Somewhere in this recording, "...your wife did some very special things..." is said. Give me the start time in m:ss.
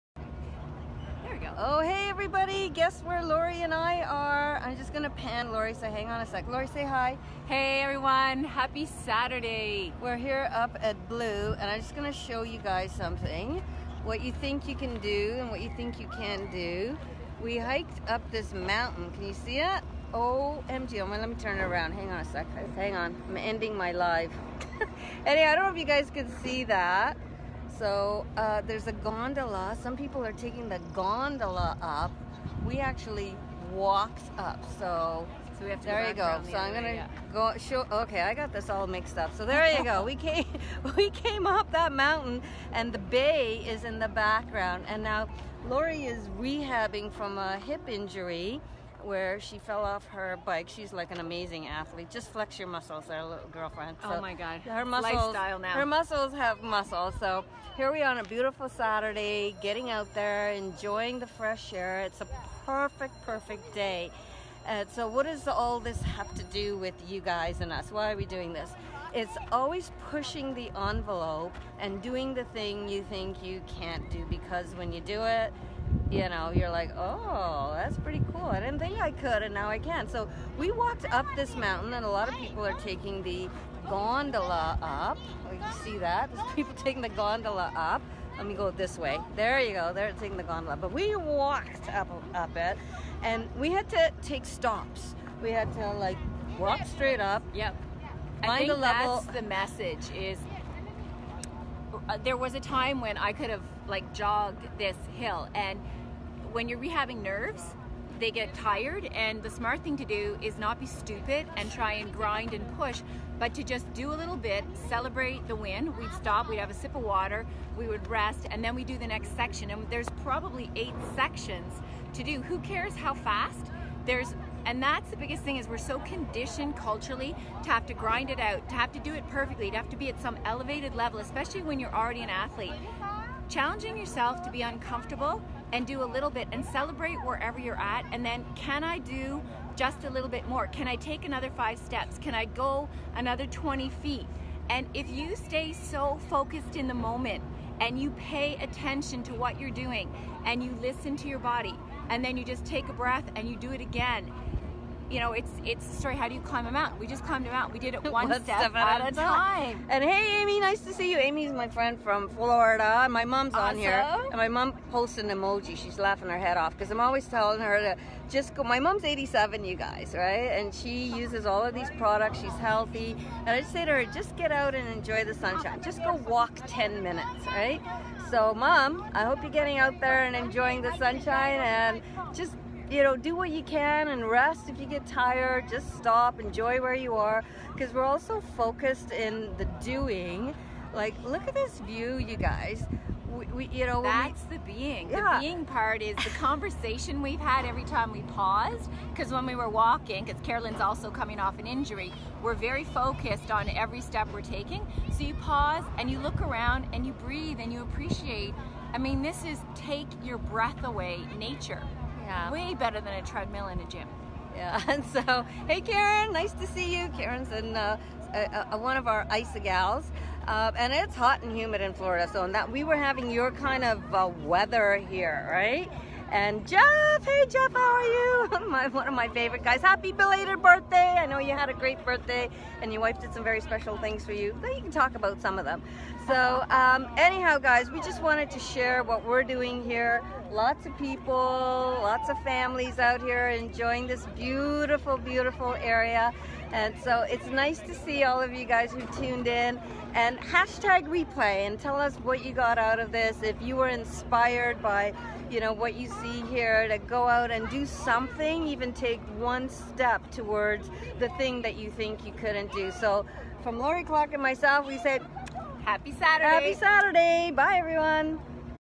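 3:52.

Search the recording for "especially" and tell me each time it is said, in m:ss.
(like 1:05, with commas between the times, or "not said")
2:11.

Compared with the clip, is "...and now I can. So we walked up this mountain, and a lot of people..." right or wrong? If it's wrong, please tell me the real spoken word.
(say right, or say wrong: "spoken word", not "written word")
right.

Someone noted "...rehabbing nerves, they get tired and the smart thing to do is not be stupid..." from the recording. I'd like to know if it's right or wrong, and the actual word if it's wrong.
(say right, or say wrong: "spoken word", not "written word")
right.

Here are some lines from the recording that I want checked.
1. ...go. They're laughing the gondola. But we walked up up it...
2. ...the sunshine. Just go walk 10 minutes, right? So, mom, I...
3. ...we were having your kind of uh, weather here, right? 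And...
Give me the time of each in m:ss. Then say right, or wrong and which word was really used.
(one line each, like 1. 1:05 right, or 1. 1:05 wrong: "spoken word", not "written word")
1. 1:29 wrong: "taking", not "laughing"
2. 2:55 right
3. 3:42 right.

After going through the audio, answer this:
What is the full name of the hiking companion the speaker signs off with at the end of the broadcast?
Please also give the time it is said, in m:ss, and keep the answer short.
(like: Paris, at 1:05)
Lori Clark, at 4:23.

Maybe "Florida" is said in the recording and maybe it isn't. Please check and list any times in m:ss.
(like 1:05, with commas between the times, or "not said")
2:42, 3:41.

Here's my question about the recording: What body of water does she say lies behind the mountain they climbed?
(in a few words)
The bay.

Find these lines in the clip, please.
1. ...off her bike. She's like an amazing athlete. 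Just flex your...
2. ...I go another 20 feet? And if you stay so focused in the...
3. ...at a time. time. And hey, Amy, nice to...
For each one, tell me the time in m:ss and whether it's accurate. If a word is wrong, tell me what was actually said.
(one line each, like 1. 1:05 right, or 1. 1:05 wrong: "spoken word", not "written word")
1. 0:49 right
2. 2:22 right
3. 2:39 right.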